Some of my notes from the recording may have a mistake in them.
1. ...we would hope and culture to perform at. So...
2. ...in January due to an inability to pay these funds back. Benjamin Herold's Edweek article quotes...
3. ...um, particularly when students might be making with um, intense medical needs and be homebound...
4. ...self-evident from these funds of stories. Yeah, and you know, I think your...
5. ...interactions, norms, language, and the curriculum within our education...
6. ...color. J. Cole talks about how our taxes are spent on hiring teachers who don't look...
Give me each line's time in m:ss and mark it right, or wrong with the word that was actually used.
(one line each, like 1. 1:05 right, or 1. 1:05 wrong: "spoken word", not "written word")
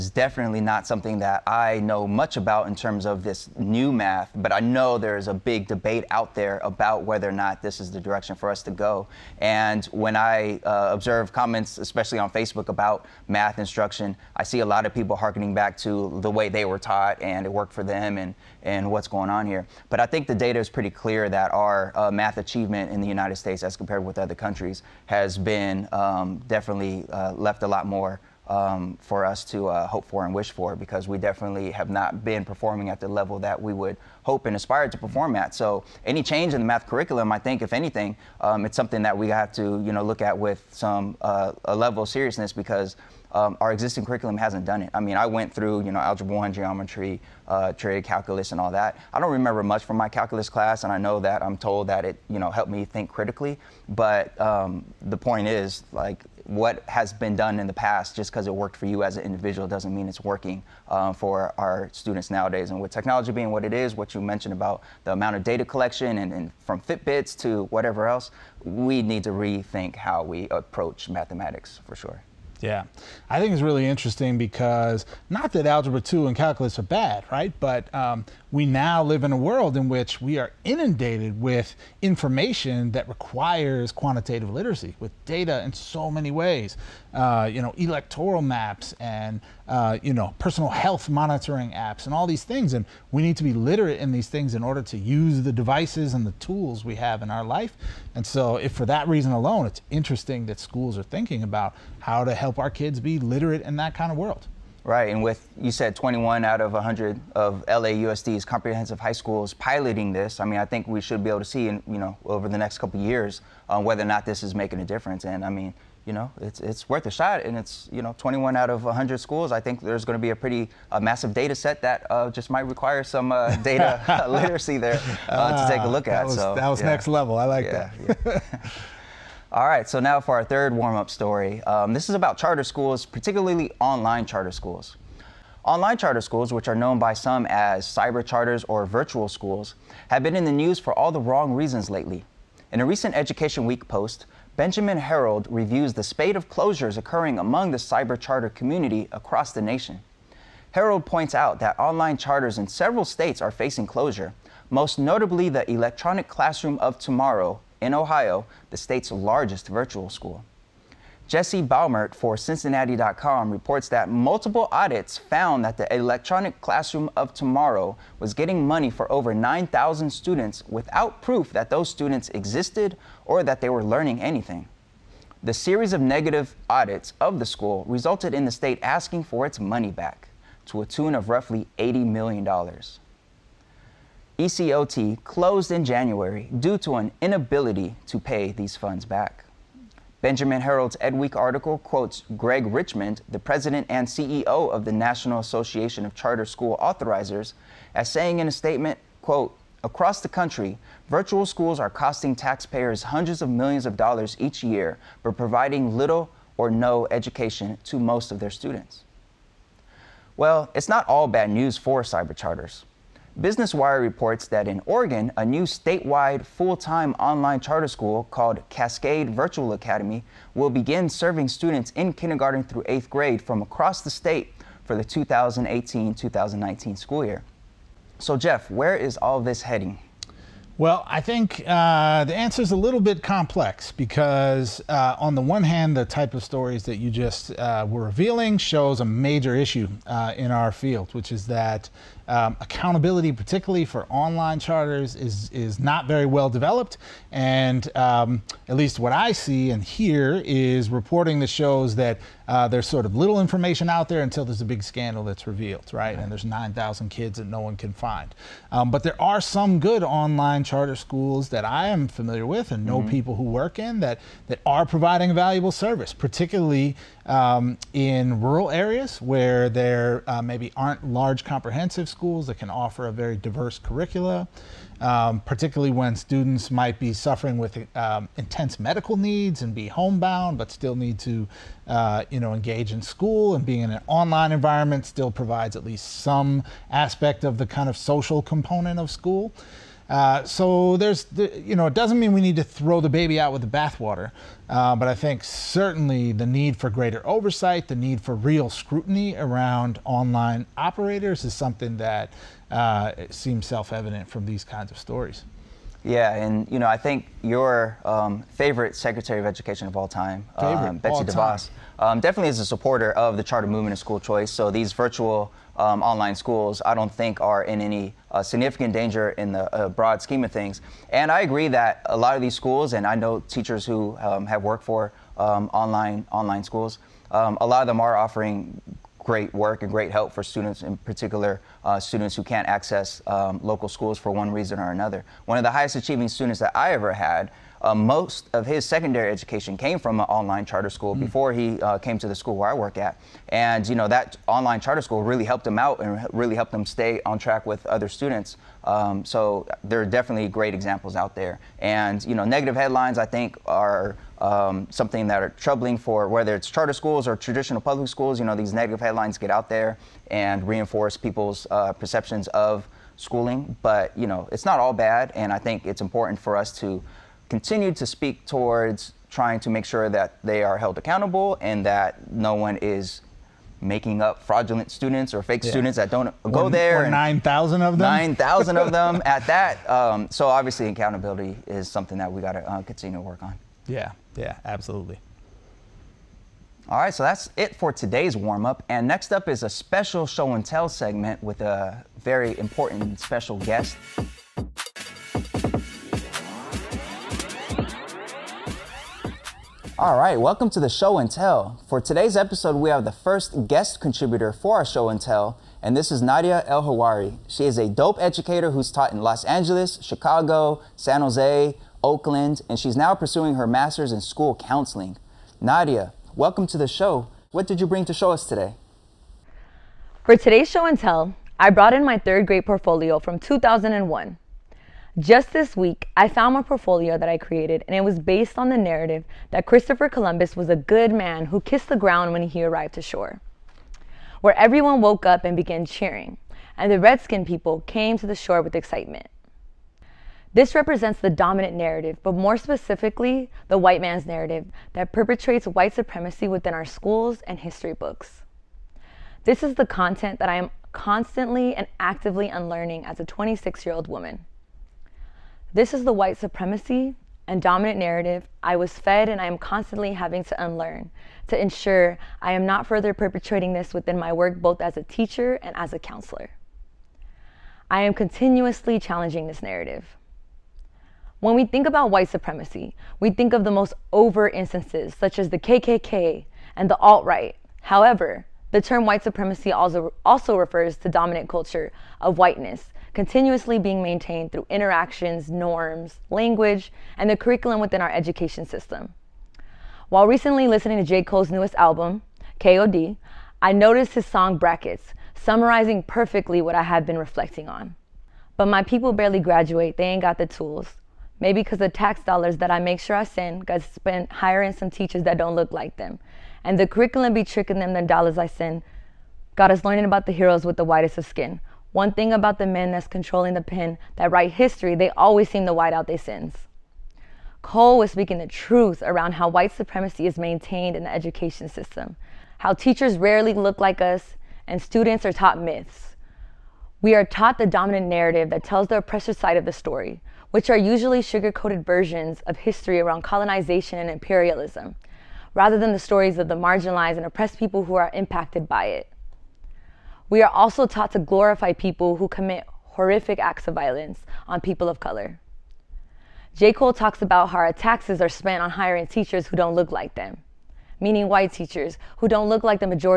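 1. 0:33 wrong: "aspire", not "culture"
2. 3:05 right
3. 4:34 wrong: "suffering", not "making"
4. 5:03 wrong: "kinds", not "funds"
5. 8:04 right
6. 9:04 right.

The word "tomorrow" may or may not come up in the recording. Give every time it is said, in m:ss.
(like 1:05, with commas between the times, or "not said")
2:36, 2:47.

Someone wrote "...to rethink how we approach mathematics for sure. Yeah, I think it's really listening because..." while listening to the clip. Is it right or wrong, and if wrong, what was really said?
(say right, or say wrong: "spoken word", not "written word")
wrong: "interesting", not "listening".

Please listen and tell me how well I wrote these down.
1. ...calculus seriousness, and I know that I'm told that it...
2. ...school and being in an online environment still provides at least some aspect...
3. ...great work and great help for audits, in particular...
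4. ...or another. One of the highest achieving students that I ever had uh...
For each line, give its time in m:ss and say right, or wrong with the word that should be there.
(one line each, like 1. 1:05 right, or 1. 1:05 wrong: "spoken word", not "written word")
1. 0:50 wrong: "class", not "seriousness"
2. 4:43 right
3. 5:29 wrong: "students", not "audits"
4. 5:34 right.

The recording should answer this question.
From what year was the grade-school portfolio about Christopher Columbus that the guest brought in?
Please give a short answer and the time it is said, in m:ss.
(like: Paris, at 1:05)
2001, at 7:03.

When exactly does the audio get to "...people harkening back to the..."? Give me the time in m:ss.
0:14.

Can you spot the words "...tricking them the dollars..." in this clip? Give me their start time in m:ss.
8:27.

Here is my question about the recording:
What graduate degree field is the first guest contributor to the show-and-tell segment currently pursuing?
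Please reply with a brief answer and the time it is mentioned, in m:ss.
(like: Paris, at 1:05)
School counseling, at 6:54.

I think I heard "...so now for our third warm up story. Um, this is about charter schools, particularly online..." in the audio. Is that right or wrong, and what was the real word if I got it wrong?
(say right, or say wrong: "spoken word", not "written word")
right.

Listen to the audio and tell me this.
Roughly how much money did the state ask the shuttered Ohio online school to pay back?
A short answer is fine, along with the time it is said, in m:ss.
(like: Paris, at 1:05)
$80 million, at 3:01.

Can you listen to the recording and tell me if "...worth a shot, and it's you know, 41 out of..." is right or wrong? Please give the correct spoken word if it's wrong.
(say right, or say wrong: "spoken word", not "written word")
wrong: "21", not "41".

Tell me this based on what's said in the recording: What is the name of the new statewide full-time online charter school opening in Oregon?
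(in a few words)
Cascade Virtual Academy.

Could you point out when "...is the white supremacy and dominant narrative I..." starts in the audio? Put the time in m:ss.
7:35.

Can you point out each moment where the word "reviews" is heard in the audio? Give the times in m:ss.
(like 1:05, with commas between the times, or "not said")
2:25.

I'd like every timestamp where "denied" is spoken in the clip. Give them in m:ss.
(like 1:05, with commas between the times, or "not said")
not said.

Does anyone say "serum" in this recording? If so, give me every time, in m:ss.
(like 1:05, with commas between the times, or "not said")
not said.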